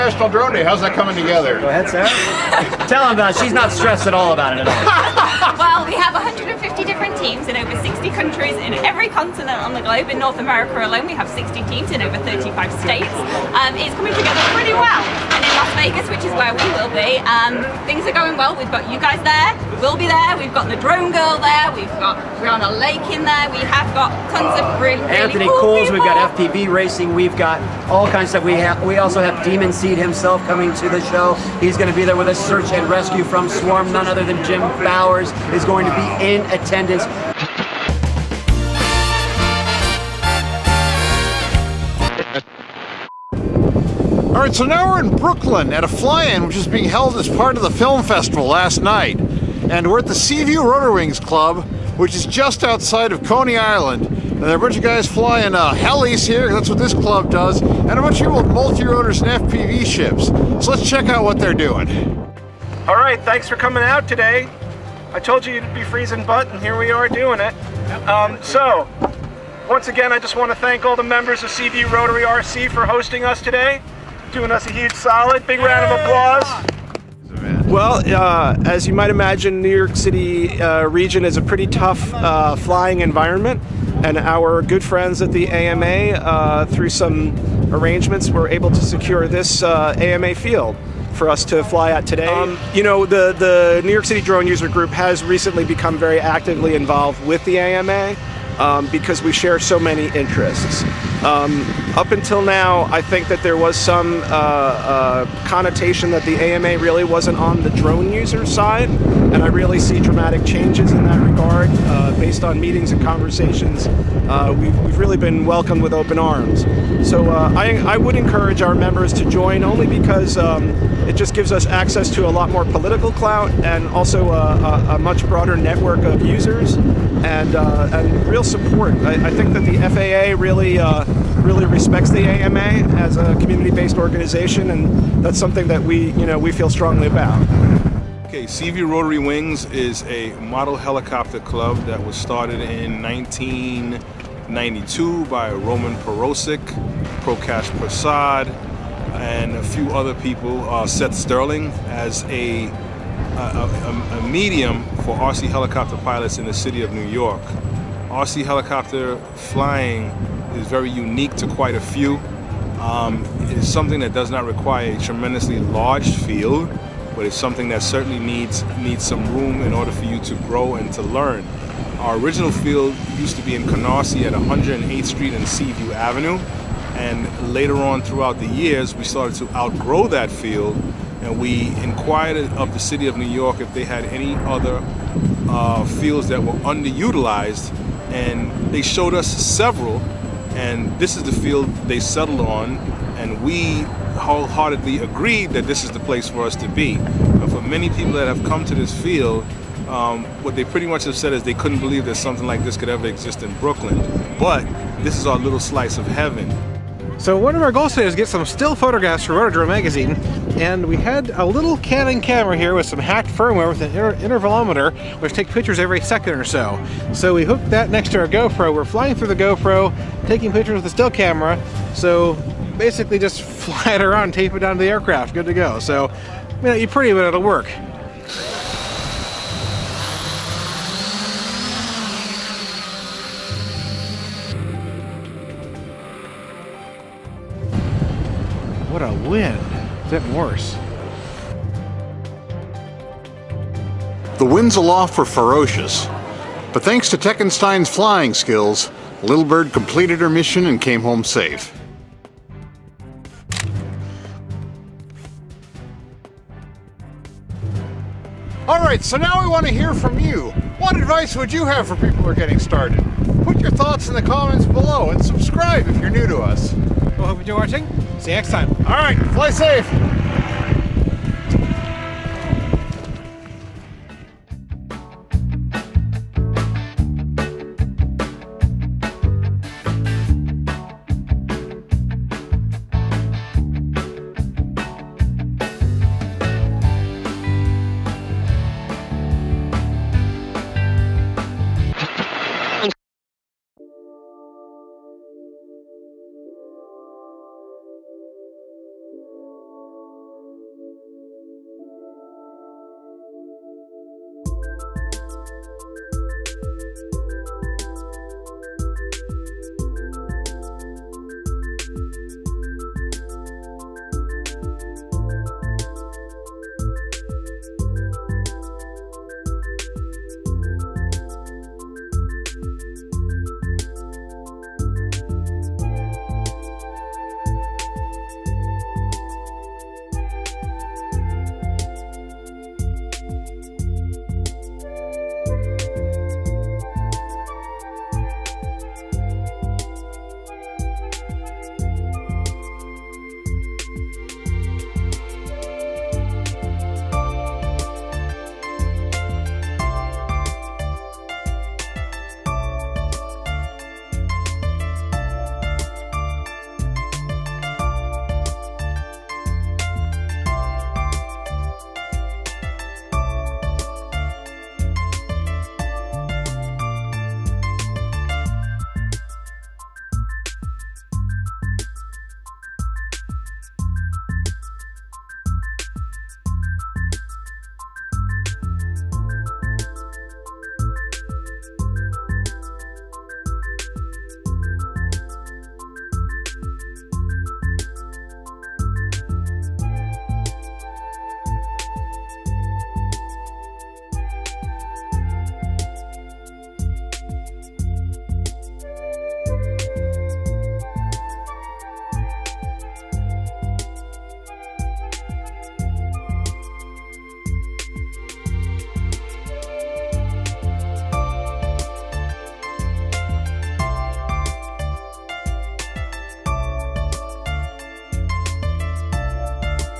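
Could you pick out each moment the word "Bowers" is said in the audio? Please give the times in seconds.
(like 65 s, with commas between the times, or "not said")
34 s.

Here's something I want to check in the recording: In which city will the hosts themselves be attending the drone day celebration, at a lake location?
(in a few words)
Las Vegas.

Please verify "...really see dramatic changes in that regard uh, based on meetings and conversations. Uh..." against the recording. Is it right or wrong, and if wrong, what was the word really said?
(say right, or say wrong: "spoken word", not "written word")
right.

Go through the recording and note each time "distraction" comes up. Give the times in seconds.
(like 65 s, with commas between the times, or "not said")
not said.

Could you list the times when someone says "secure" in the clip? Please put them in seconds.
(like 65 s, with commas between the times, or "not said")
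88 s.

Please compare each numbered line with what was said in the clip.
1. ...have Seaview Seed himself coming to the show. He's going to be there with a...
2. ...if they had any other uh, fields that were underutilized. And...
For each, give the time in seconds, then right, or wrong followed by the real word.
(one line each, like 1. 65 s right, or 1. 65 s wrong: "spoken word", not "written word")
1. 29 s wrong: "Demon", not "Seaview"
2. 183 s right.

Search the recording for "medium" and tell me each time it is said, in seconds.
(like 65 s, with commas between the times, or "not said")
154 s.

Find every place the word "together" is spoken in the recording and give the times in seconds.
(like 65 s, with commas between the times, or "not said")
1 s, 14 s.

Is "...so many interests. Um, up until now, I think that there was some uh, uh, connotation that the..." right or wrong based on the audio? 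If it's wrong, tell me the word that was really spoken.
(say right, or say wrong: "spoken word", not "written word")
right.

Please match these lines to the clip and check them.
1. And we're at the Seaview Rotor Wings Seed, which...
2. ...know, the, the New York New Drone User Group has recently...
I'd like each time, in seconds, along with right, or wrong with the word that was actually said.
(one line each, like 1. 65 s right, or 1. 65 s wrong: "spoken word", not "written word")
1. 49 s wrong: "Club", not "Seed"
2. 92 s wrong: "City", not "New".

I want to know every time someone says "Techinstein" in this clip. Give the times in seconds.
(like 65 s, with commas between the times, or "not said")
247 s.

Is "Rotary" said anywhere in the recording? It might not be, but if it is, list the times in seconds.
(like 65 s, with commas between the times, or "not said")
71 s, 138 s.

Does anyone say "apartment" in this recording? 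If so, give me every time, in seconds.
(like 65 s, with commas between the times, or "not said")
not said.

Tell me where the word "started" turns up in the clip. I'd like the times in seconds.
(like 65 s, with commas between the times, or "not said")
142 s, 179 s, 262 s.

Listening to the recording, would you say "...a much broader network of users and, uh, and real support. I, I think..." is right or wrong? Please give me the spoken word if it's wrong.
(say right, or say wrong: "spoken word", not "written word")
right.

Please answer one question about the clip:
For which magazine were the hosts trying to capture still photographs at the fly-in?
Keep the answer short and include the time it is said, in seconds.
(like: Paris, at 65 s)
Rotor Drone, at 209 s.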